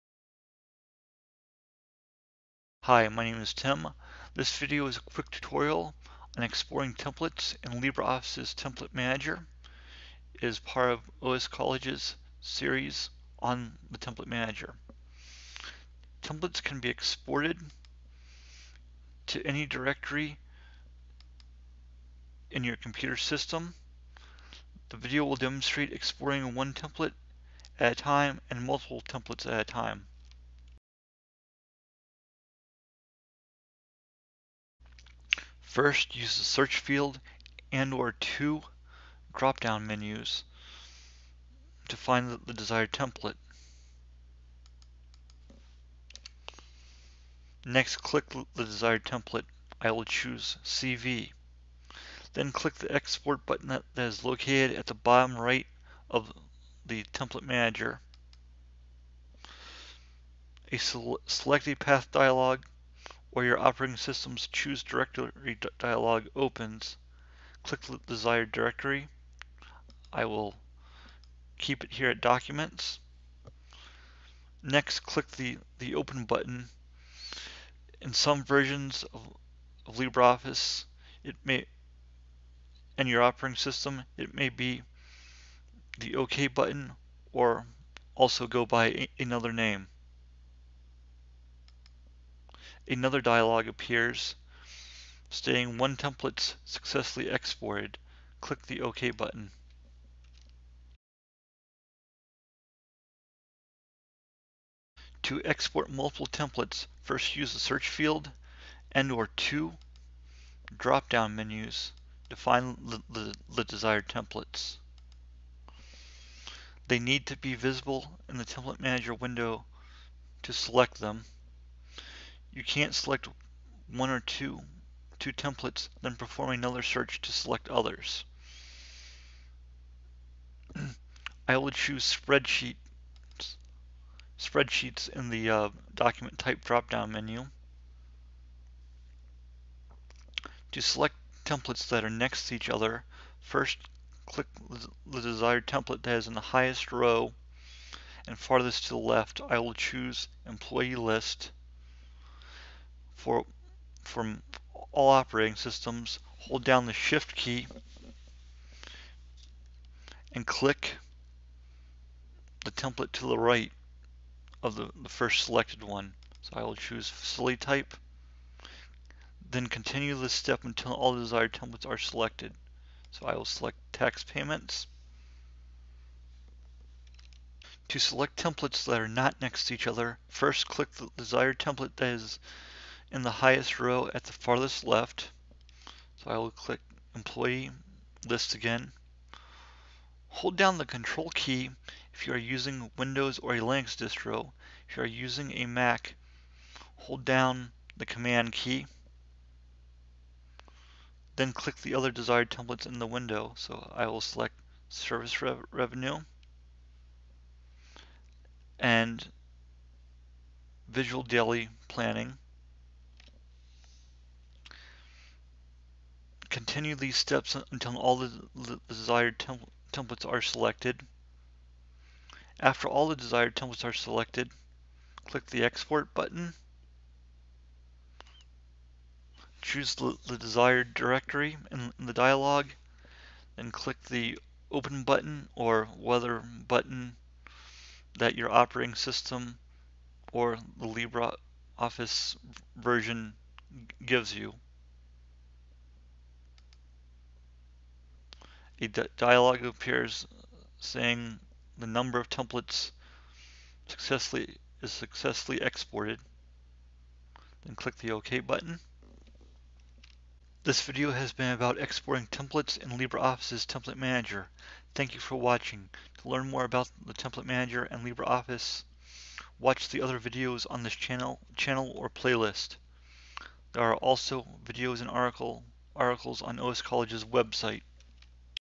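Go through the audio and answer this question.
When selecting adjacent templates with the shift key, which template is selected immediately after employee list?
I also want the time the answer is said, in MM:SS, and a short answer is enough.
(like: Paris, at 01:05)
Facility type, at 02:47.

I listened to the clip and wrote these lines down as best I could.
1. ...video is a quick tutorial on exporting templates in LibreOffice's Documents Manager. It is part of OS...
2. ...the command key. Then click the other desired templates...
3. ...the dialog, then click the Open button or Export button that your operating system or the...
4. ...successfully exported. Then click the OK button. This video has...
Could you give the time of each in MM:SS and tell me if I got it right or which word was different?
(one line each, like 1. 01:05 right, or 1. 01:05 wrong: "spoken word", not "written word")
1. 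00:04 wrong: "Template", not "Documents"
2. 03:17 right
3. 03:52 wrong: "Weather", not "Export"
4. 04:14 right.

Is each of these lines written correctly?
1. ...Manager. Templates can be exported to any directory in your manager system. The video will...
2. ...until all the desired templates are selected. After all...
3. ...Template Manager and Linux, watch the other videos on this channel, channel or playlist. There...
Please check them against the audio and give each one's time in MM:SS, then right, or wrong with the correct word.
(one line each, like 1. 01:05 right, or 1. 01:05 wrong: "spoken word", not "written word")
1. 00:14 wrong: "computer", not "manager"
2. 03:37 right
3. 04:27 wrong: "LibreOffice", not "Linux".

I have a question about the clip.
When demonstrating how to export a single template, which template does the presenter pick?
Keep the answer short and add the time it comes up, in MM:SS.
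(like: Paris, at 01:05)
CV, at 00:50.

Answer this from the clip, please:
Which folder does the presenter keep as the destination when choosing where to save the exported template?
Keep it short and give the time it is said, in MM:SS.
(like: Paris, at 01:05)
Documents, at 01:12.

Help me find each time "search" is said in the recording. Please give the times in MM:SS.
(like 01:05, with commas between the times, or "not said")
00:36, 01:47, 02:06.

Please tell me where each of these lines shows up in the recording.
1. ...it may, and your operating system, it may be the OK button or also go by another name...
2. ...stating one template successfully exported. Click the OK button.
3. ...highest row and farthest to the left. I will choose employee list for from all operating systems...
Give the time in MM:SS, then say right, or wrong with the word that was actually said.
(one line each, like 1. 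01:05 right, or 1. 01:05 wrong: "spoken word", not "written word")
1. 01:21 right
2. 01:35 right
3. 02:26 right.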